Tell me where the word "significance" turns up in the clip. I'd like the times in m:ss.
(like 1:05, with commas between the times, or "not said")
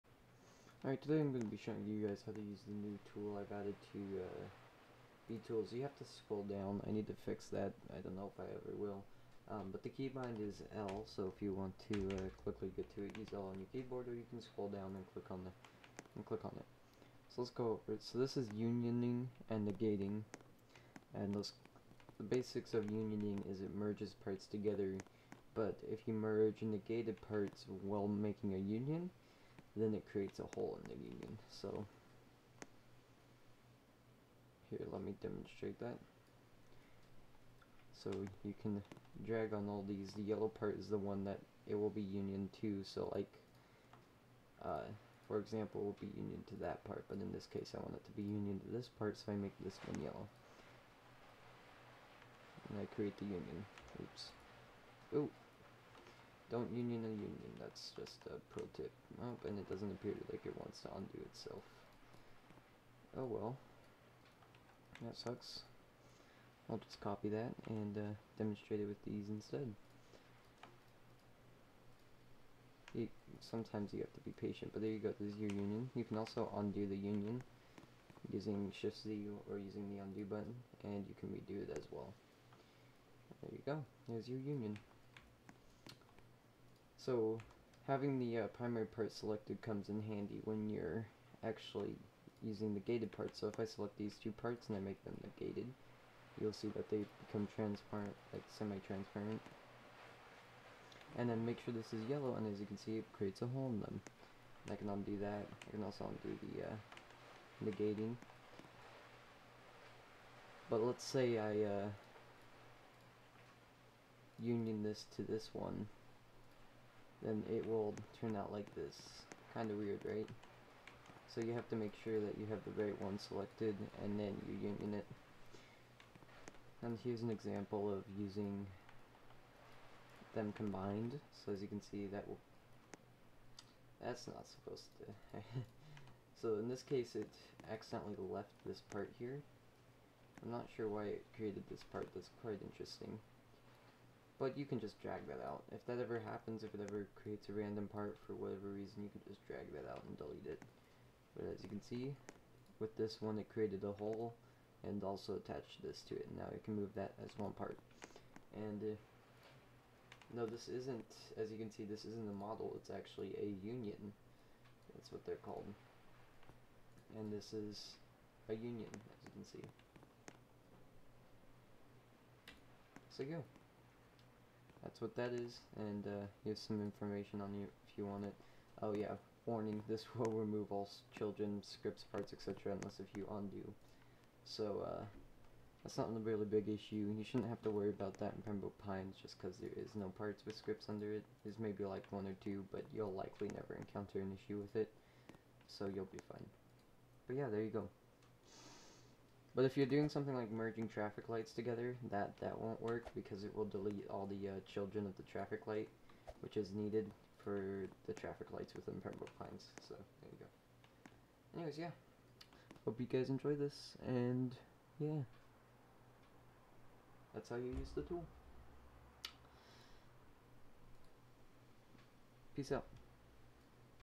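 not said.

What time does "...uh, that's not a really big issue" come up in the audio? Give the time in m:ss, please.
3:04.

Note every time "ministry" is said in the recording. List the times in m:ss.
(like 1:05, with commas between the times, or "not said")
not said.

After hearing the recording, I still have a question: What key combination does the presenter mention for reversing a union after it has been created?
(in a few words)
Shift Z.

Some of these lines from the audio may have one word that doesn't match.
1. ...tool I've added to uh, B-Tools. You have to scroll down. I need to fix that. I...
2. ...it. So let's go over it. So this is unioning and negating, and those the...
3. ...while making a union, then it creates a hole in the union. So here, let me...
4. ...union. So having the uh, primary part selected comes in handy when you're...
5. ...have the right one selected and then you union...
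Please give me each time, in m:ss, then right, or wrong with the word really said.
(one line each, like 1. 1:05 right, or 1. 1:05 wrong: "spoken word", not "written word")
1. 0:03 right
2. 0:16 right
3. 0:27 right
4. 1:24 right
5. 2:02 right.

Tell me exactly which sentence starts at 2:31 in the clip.
But as you can see, with this one it created a hole and also attached this to it.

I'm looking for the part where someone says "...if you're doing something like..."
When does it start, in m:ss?
3:19.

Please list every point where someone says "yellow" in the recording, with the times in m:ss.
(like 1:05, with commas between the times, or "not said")
0:40, 0:50, 1:42.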